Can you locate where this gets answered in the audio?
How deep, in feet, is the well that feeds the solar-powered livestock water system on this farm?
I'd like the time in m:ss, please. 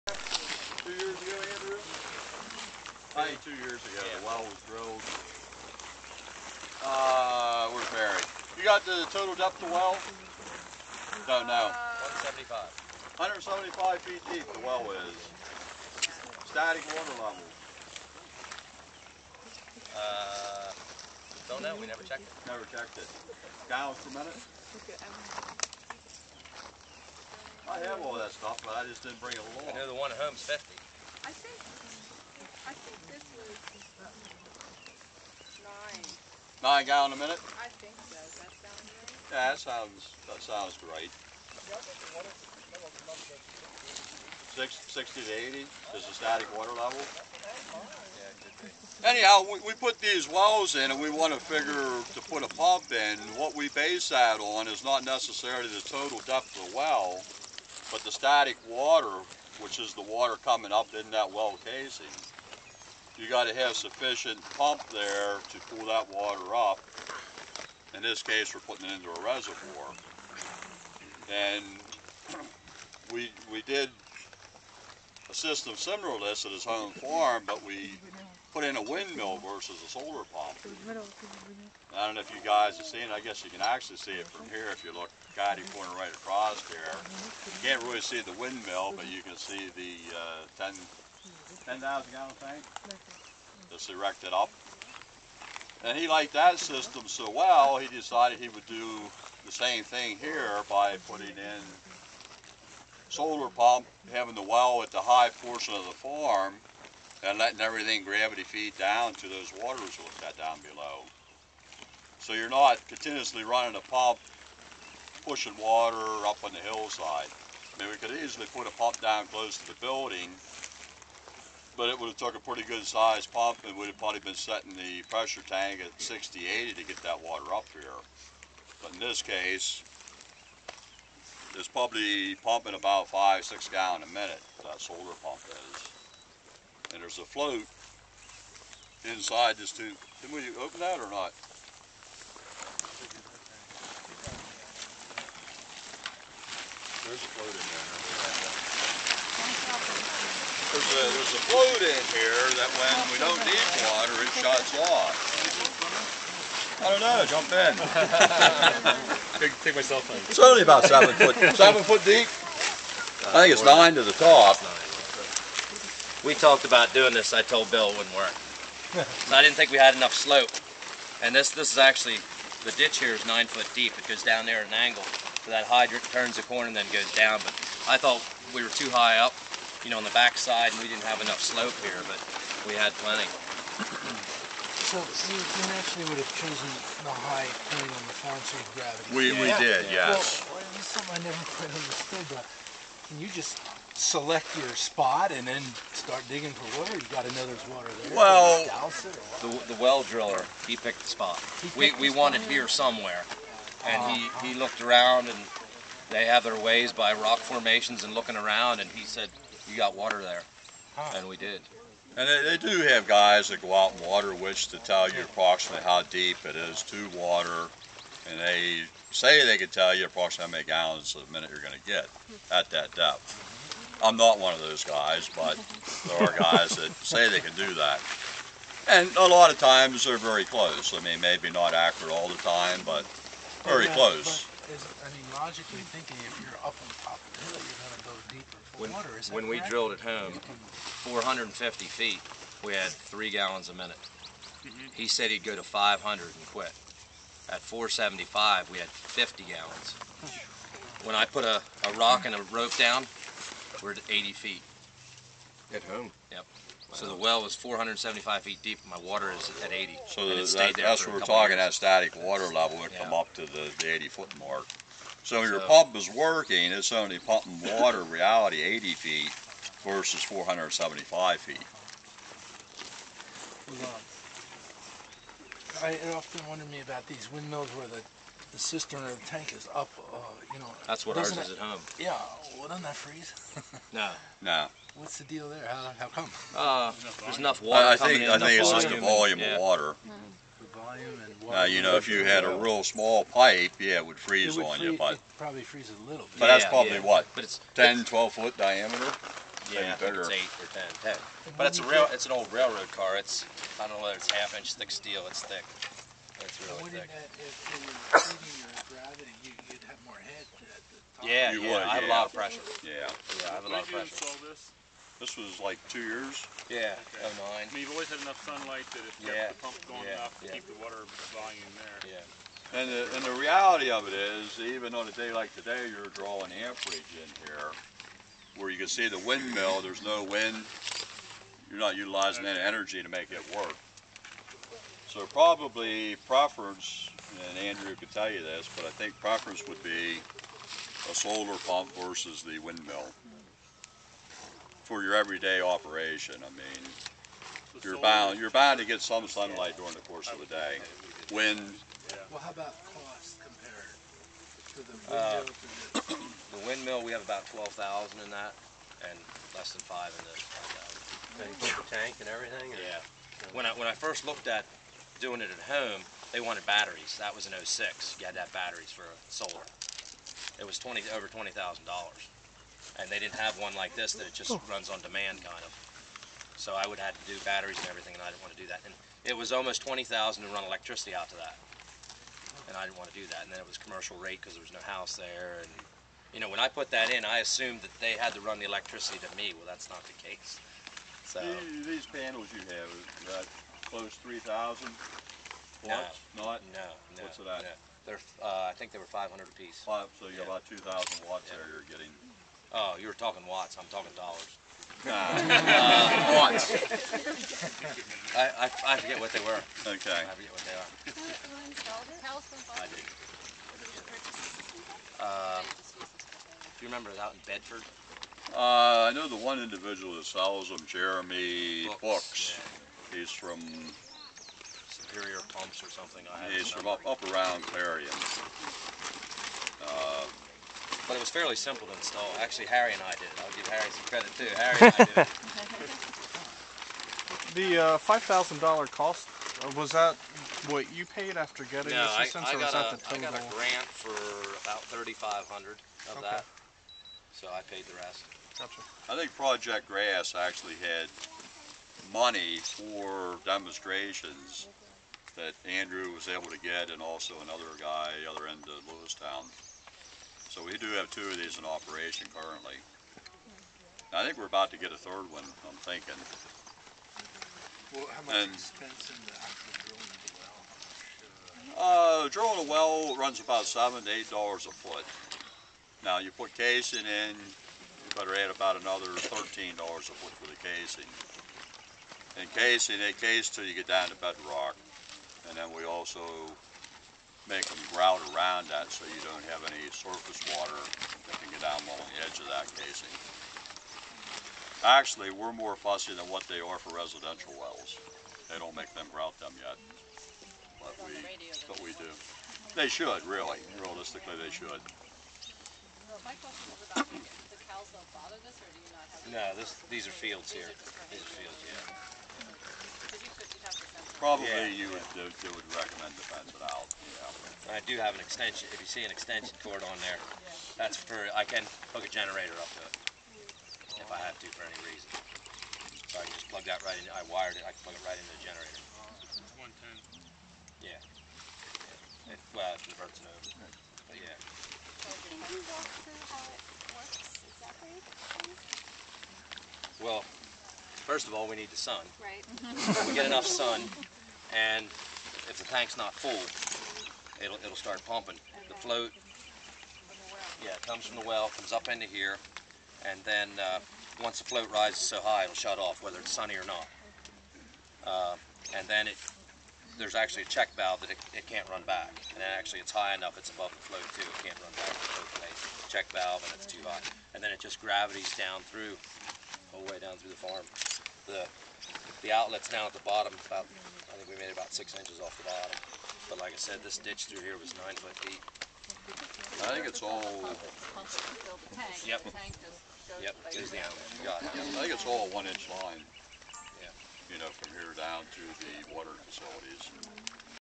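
0:13.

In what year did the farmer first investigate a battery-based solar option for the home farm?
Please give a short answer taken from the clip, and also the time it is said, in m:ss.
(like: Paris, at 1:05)
2006, at 6:07.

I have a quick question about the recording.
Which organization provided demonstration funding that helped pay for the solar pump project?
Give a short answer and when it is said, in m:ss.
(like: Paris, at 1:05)
Project Grass, at 7:29.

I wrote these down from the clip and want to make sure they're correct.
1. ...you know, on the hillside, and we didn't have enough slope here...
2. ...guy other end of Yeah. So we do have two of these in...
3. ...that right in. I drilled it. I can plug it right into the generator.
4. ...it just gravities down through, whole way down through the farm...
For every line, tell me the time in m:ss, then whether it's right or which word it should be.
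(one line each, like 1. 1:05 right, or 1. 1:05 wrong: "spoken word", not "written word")
1. 2:59 wrong: "backside", not "hillside"
2. 7:37 wrong: "Lewistown", not "Yeah"
3. 8:46 wrong: "wired", not "drilled"
4. 9:27 right.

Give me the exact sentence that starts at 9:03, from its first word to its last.
we get enough sun, and if the tank's not full, it'll it'll start pumping.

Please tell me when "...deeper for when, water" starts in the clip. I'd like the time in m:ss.
3:58.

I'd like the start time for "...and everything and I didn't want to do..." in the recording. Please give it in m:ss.
6:17.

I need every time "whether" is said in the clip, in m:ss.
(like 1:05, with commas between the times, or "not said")
5:04, 9:16.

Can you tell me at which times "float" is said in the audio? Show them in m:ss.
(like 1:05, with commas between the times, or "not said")
2:17, 2:27, 2:31, 9:08, 9:14, 9:23.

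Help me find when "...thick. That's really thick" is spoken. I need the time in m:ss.
5:05.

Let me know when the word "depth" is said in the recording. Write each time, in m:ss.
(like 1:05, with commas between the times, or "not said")
0:09, 0:56, 3:42.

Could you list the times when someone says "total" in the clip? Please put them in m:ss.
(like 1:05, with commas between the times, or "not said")
0:09, 0:55, 7:23.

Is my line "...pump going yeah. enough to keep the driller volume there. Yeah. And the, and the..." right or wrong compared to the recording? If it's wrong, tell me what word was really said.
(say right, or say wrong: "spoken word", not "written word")
wrong: "water", not "driller".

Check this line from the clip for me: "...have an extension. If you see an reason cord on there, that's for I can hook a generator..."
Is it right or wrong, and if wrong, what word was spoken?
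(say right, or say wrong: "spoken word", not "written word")
wrong: "extension", not "reason".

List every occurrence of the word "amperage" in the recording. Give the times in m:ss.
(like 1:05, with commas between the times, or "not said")
5:26.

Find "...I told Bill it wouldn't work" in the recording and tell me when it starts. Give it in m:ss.
2:47.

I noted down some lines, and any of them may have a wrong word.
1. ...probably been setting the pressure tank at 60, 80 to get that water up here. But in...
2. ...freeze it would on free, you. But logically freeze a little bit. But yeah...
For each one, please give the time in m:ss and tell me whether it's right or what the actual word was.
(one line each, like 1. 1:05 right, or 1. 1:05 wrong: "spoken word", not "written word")
1. 2:03 right
2. 4:54 wrong: "probably", not "logically".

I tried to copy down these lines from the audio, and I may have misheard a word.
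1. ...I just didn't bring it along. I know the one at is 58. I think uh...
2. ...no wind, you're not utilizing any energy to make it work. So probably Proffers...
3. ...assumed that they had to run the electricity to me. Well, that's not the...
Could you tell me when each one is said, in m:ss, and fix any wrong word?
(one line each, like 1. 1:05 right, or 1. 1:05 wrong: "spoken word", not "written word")
1. 0:28 wrong: "50", not "58"
2. 5:30 right
3. 6:27 right.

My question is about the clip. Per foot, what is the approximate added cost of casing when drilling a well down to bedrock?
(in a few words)
13 dollars.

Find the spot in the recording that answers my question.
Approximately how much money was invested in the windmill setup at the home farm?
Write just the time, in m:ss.
5:57.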